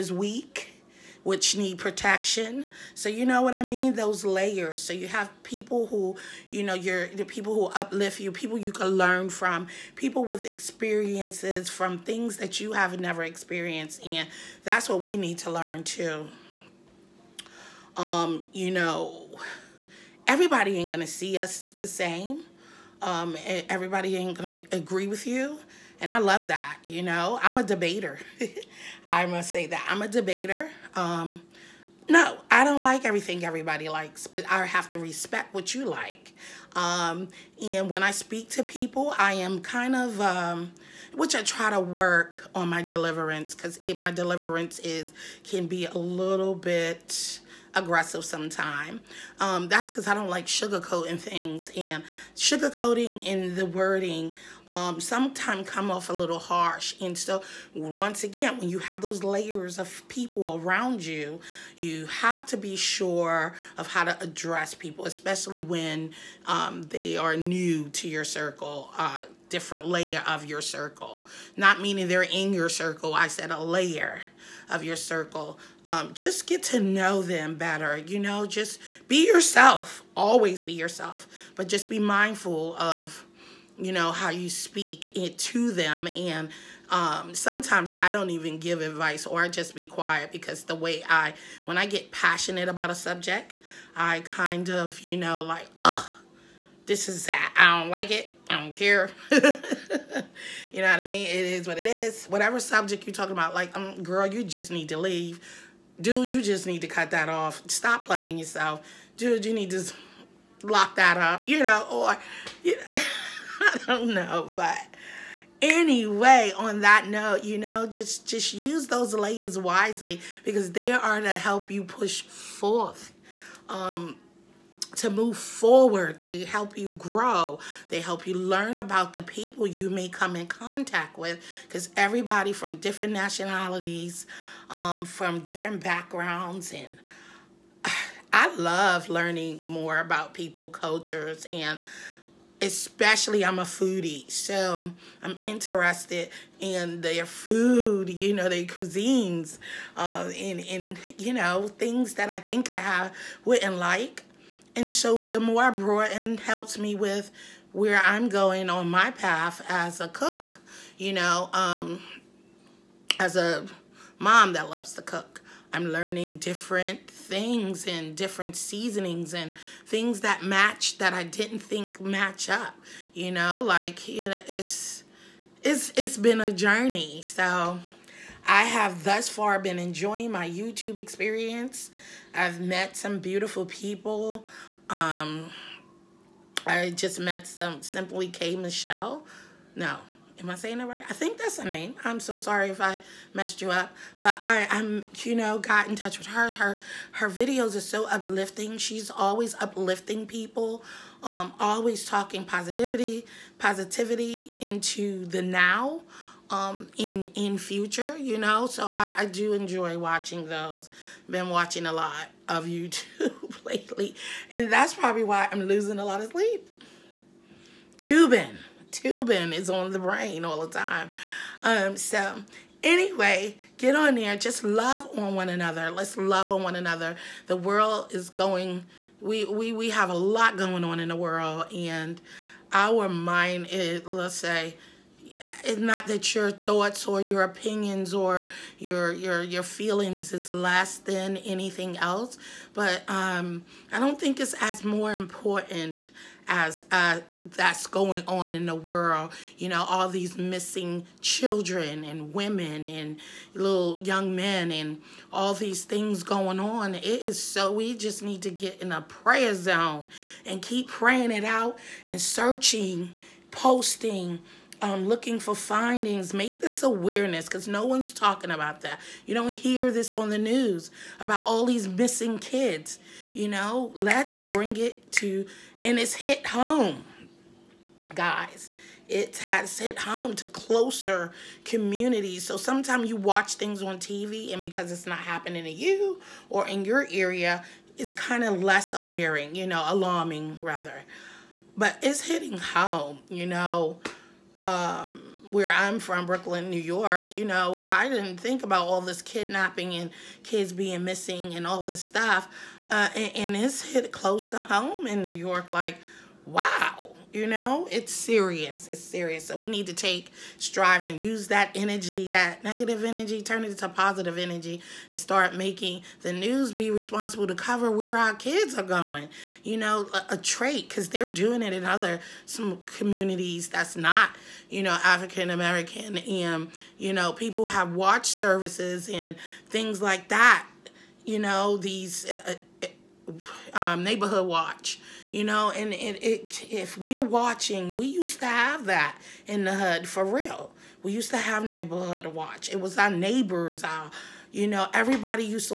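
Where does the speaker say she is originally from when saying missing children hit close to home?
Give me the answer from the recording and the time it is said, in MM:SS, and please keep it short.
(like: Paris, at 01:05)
Brooklyn, New York, at 04:56.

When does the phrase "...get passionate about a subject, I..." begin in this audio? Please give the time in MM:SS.
01:31.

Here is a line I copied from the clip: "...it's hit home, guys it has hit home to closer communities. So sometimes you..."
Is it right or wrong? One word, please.
right.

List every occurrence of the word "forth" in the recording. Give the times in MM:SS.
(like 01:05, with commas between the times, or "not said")
02:02.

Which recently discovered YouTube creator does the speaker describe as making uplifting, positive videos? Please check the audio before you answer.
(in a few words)
Simply K Michelle.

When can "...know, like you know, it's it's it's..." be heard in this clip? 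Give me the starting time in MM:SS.
02:53.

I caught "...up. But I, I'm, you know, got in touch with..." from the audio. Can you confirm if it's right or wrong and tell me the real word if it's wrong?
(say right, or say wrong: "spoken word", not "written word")
right.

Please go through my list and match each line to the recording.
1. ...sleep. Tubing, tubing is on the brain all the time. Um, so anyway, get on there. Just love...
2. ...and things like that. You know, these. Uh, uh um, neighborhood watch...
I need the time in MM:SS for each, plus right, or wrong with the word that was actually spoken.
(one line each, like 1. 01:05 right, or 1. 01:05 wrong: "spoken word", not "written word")
1. 03:36 right
2. 05:29 right.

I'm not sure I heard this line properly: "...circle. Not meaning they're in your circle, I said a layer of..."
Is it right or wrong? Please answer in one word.
right.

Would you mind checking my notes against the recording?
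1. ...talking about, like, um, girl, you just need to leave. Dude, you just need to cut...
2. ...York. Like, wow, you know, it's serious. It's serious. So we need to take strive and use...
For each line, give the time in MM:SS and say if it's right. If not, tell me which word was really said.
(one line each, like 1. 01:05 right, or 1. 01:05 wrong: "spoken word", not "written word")
1. 01:43 right
2. 05:05 right.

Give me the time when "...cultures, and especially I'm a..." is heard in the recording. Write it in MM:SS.
02:20.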